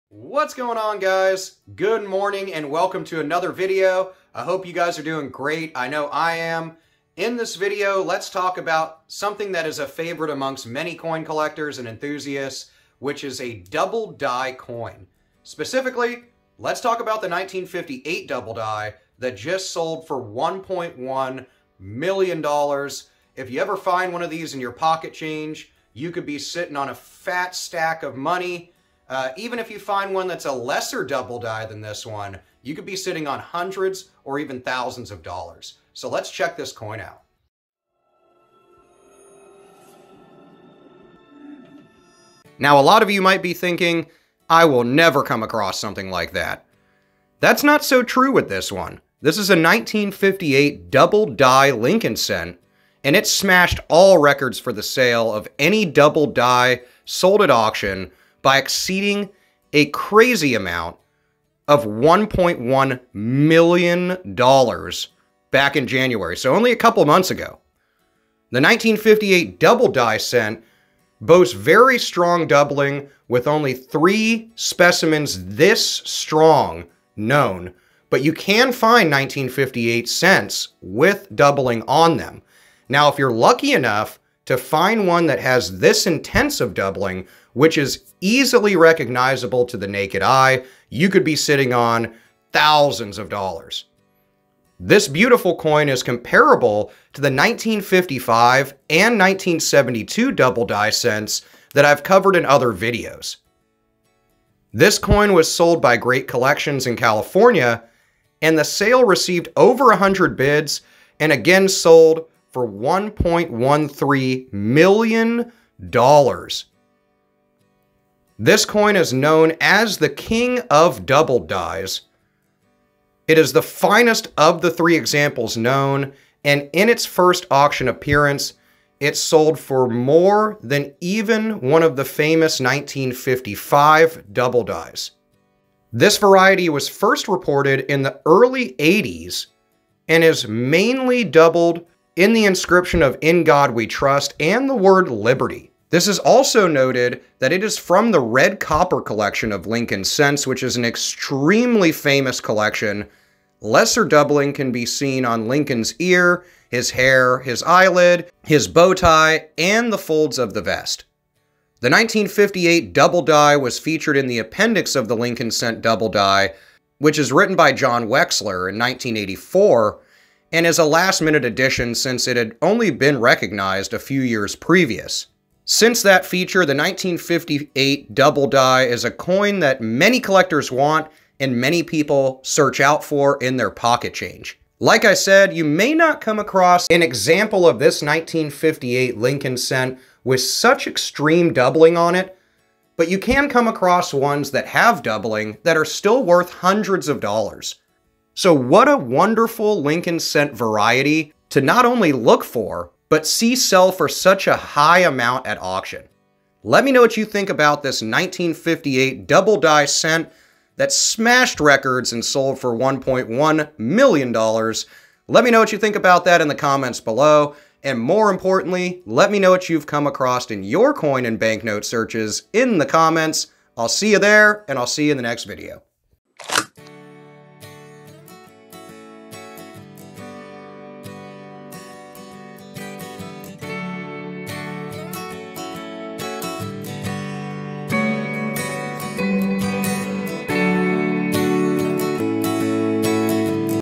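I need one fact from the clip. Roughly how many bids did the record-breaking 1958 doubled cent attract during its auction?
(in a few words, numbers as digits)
over 100.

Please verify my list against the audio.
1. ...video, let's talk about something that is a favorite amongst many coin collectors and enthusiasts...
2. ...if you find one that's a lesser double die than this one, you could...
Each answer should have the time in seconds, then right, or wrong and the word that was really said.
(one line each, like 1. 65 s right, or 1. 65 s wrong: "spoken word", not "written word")
1. 7 s right
2. 29 s right.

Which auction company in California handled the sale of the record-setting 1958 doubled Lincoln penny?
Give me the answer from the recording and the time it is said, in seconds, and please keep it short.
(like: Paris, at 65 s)
Great Collections, at 105 s.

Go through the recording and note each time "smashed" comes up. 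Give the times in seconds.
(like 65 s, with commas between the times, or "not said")
53 s, 210 s.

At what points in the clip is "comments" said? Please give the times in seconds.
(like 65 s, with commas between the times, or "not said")
216 s, 222 s.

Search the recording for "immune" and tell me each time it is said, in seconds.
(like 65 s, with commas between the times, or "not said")
not said.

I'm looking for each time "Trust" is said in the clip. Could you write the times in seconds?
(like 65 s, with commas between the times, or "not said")
143 s.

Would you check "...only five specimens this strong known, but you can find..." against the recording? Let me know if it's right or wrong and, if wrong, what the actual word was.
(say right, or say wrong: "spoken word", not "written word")
wrong: "three", not "five".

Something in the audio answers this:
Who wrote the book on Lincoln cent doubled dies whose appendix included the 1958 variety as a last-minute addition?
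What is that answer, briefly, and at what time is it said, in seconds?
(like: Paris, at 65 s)
John Wexler, at 167 s.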